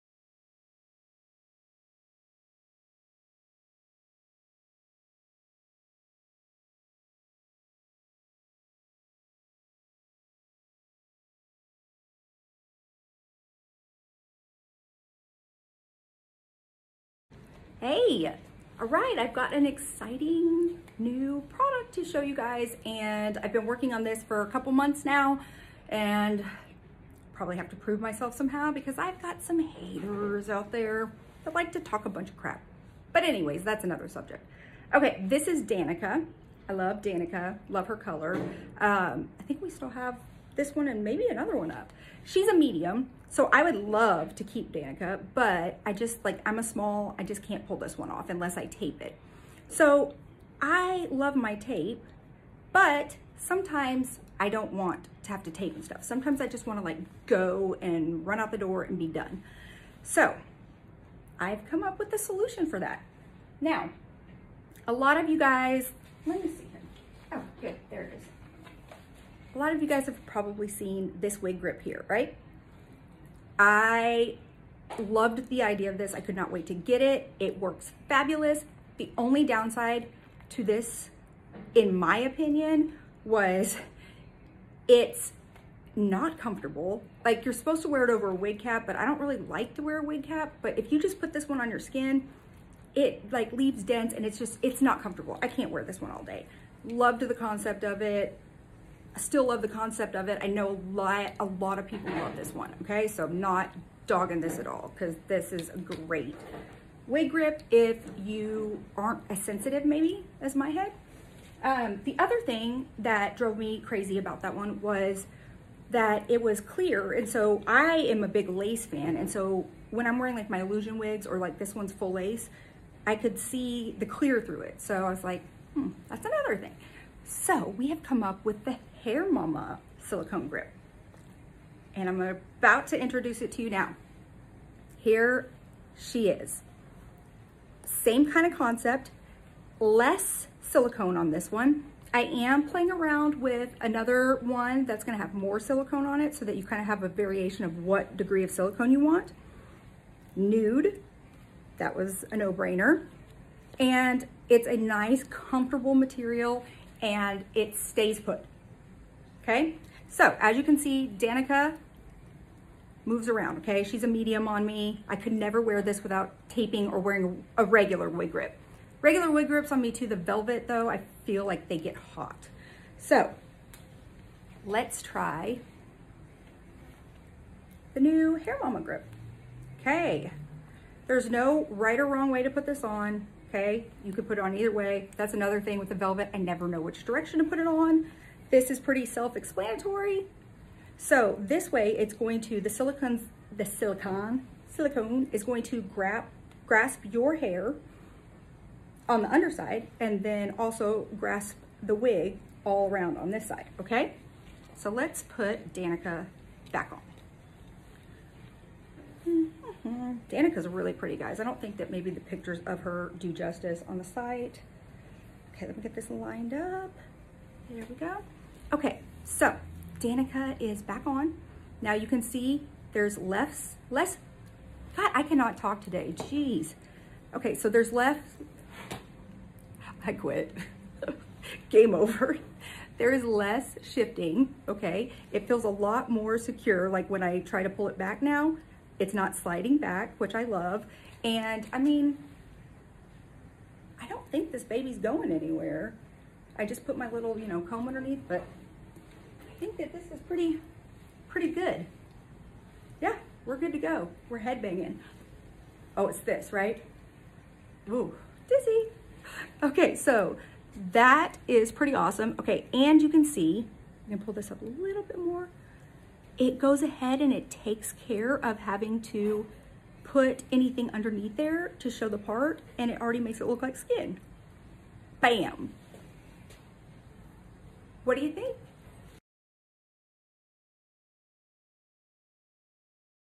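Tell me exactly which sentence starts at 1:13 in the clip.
I loved the idea of this.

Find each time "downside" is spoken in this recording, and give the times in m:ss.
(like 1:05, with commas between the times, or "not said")
1:19.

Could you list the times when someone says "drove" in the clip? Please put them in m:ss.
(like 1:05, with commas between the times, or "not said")
1:53.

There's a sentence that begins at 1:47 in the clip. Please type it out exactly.
Wig grip if you aren't as sensitive maybe as my head.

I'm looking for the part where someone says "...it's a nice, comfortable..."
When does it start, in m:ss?
2:34.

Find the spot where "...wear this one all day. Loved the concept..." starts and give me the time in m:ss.
1:35.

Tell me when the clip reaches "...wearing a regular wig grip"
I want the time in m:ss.
2:46.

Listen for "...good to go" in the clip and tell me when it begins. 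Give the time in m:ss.
4:13.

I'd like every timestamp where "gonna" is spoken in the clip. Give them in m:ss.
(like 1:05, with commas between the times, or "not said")
2:25, 4:24.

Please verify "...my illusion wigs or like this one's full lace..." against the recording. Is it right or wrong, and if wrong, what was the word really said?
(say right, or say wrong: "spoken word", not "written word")
right.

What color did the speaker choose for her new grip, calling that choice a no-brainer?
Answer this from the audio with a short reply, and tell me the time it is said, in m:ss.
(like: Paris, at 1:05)
Nude, at 2:30.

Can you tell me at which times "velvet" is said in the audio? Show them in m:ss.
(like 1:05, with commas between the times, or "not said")
2:50, 3:05.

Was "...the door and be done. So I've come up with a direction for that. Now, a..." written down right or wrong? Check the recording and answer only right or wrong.
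wrong.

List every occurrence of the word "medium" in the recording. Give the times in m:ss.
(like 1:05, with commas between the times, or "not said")
0:42, 2:44.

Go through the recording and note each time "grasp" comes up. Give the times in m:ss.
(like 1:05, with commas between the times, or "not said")
3:16, 3:21.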